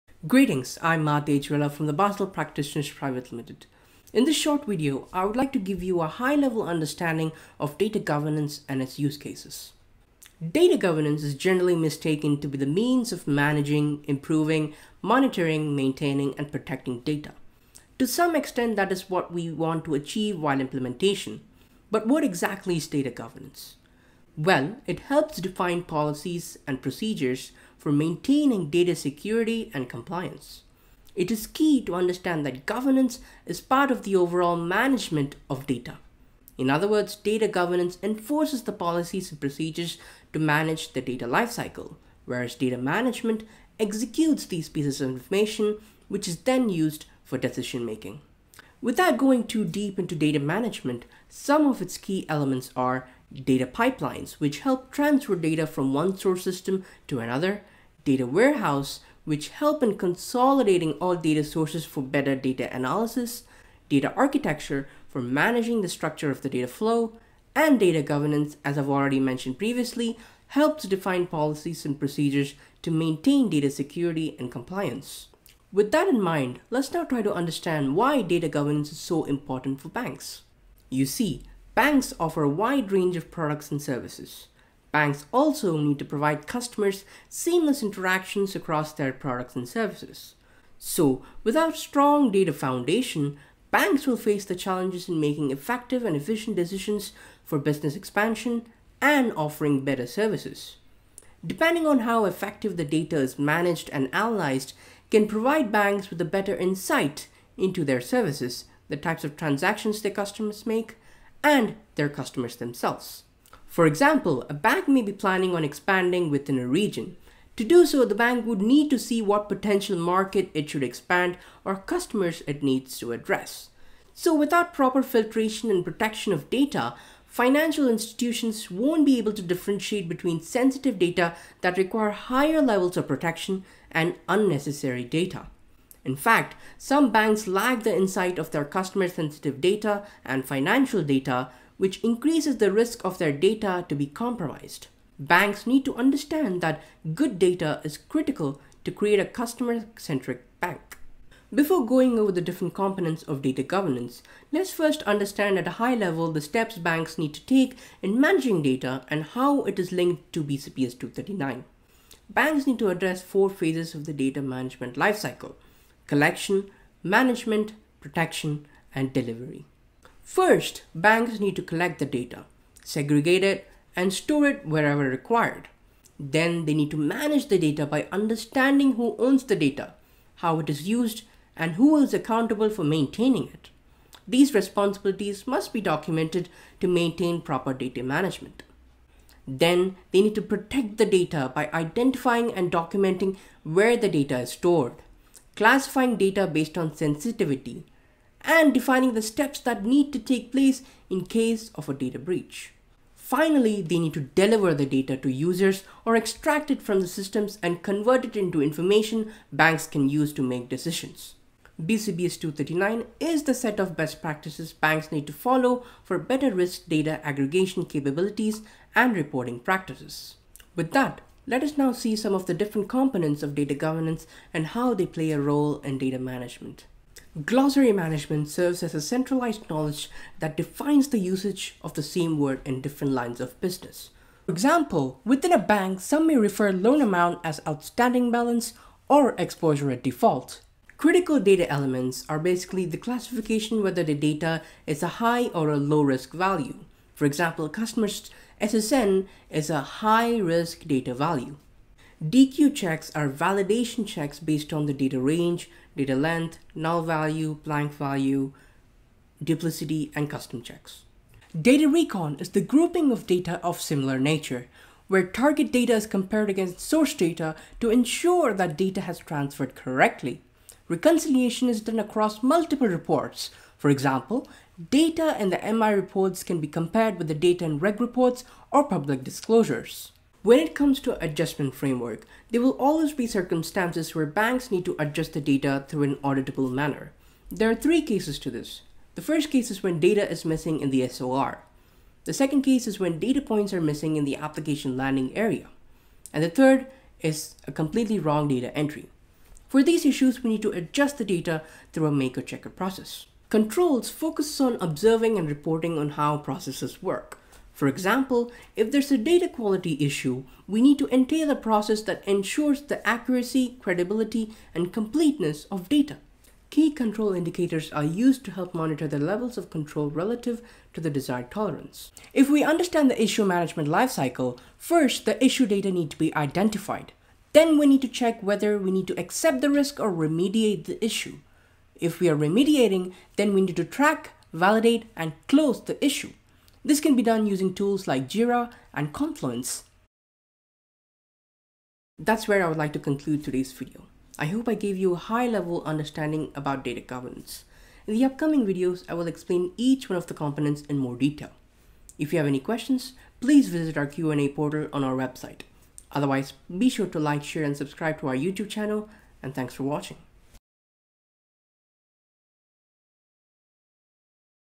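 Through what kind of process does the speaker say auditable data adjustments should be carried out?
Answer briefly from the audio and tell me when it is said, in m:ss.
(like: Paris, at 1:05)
Maker checker process, at 5:02.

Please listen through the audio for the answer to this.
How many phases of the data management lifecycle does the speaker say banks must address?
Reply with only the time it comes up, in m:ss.
2:43.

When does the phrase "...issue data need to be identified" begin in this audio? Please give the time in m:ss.
5:25.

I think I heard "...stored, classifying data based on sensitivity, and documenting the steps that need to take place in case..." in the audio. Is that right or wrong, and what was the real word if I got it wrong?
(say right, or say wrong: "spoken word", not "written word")
wrong: "defining", not "documenting".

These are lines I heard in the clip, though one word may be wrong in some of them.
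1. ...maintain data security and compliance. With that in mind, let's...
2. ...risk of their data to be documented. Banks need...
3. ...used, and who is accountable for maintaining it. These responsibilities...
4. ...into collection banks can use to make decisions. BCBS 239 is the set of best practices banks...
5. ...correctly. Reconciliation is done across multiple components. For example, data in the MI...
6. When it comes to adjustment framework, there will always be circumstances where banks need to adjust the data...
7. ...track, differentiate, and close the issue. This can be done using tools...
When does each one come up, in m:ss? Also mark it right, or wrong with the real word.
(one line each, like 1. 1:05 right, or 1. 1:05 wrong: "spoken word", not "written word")
1. 1:12 right
2. 2:22 wrong: "compromised", not "documented"
3. 3:00 right
4. 3:28 wrong: "information", not "collection"
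5. 4:29 wrong: "reports", not "components"
6. 4:40 right
7. 5:33 wrong: "validate", not "differentiate".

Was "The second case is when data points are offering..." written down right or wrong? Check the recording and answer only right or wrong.
wrong.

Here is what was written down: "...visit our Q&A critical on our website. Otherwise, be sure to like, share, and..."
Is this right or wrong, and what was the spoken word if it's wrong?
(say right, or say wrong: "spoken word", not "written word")
wrong: "portal", not "critical".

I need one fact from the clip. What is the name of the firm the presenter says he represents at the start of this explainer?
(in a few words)
Basel Practitioners Private Limited.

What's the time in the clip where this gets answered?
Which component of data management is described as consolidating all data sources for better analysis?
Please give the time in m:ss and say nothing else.
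0:58.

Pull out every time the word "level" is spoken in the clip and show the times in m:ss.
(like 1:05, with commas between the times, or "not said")
0:06, 2:12, 2:35, 5:19, 5:45.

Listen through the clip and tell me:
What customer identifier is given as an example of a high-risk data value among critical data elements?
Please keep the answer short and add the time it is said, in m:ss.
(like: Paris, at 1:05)
SSN, at 4:08.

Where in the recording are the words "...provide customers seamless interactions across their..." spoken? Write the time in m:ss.
1:26.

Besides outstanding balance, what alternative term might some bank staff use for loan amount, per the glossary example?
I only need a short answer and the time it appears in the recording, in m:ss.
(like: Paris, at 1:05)
Exposure at default, at 3:59.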